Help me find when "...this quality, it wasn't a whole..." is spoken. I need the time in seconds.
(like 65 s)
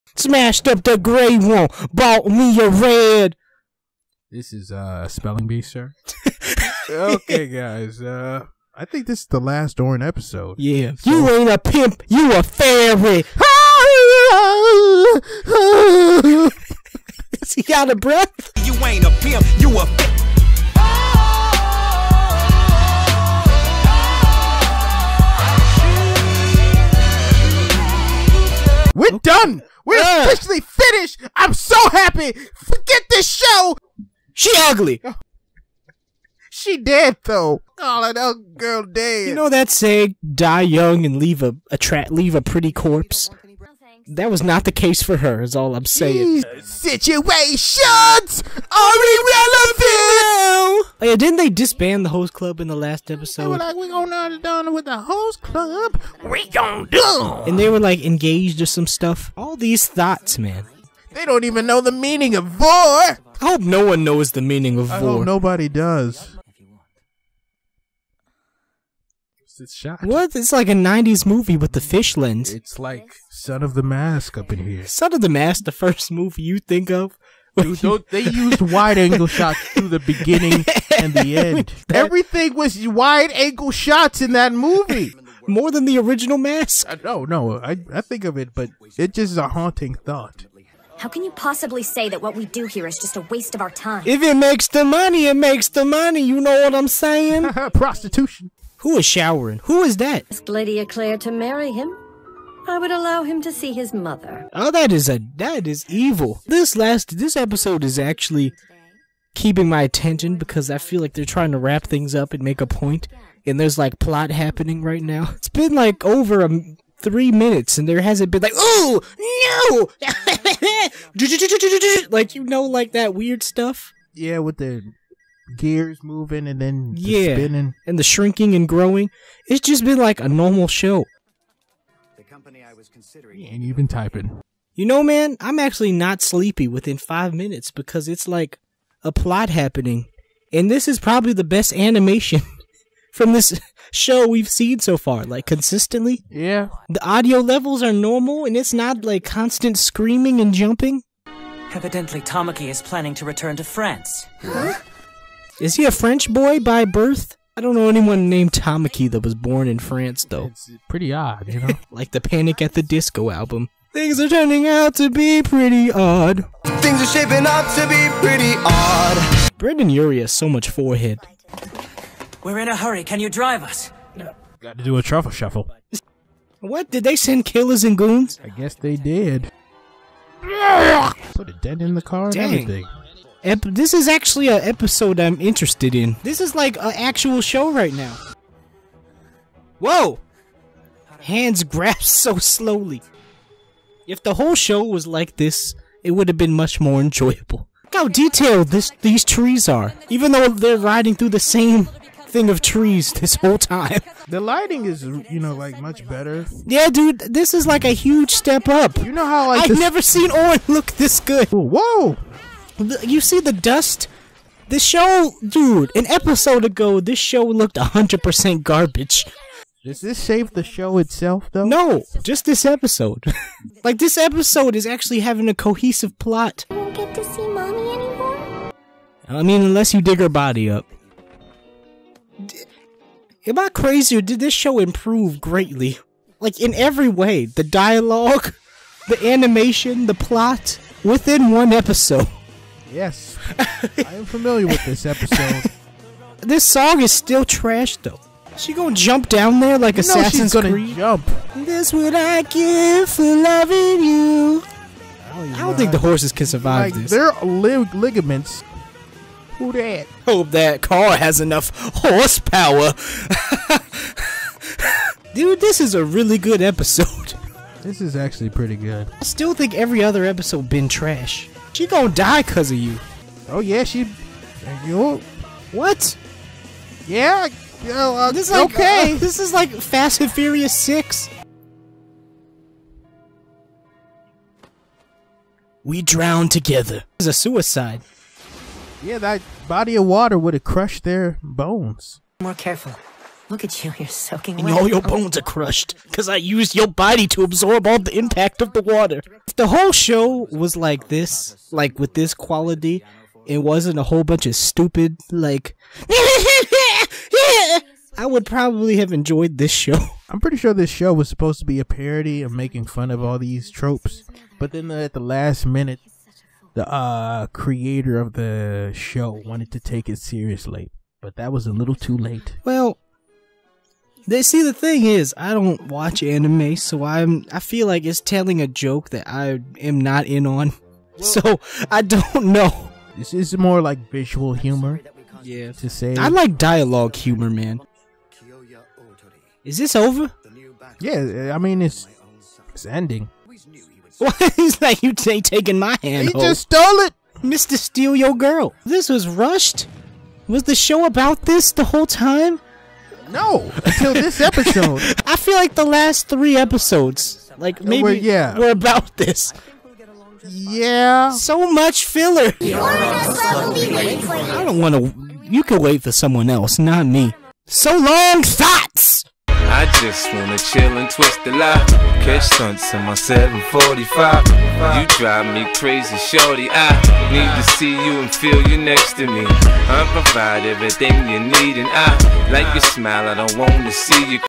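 302 s.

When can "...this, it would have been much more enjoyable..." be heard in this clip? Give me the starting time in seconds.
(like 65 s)
195 s.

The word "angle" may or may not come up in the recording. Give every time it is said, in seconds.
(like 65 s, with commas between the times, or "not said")
78 s, 83 s.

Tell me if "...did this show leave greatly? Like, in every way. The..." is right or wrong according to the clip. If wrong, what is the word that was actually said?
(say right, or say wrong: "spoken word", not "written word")
wrong: "improve", not "leave".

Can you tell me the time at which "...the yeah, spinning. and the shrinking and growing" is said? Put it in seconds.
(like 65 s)
126 s.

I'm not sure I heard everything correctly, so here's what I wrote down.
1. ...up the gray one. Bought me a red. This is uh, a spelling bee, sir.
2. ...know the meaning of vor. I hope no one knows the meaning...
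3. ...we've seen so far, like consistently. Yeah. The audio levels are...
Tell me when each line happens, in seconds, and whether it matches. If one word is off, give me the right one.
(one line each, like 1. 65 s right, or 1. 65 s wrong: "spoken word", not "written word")
1. 0 s right
2. 61 s right
3. 144 s right.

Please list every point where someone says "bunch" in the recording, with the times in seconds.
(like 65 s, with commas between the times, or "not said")
304 s.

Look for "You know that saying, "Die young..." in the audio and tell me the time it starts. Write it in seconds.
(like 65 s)
39 s.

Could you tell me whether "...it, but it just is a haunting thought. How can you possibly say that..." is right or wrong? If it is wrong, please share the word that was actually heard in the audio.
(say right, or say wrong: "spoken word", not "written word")
right.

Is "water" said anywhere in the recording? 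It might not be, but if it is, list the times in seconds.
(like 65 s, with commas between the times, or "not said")
290 s, 298 s.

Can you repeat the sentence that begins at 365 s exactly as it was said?
You can wait for someone else, not me.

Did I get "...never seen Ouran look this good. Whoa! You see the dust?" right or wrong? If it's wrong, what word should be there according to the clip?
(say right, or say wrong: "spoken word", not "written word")
right.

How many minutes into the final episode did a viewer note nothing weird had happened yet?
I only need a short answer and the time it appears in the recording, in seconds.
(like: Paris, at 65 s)
3, at 116 s.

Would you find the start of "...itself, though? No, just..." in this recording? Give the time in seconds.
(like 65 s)
220 s.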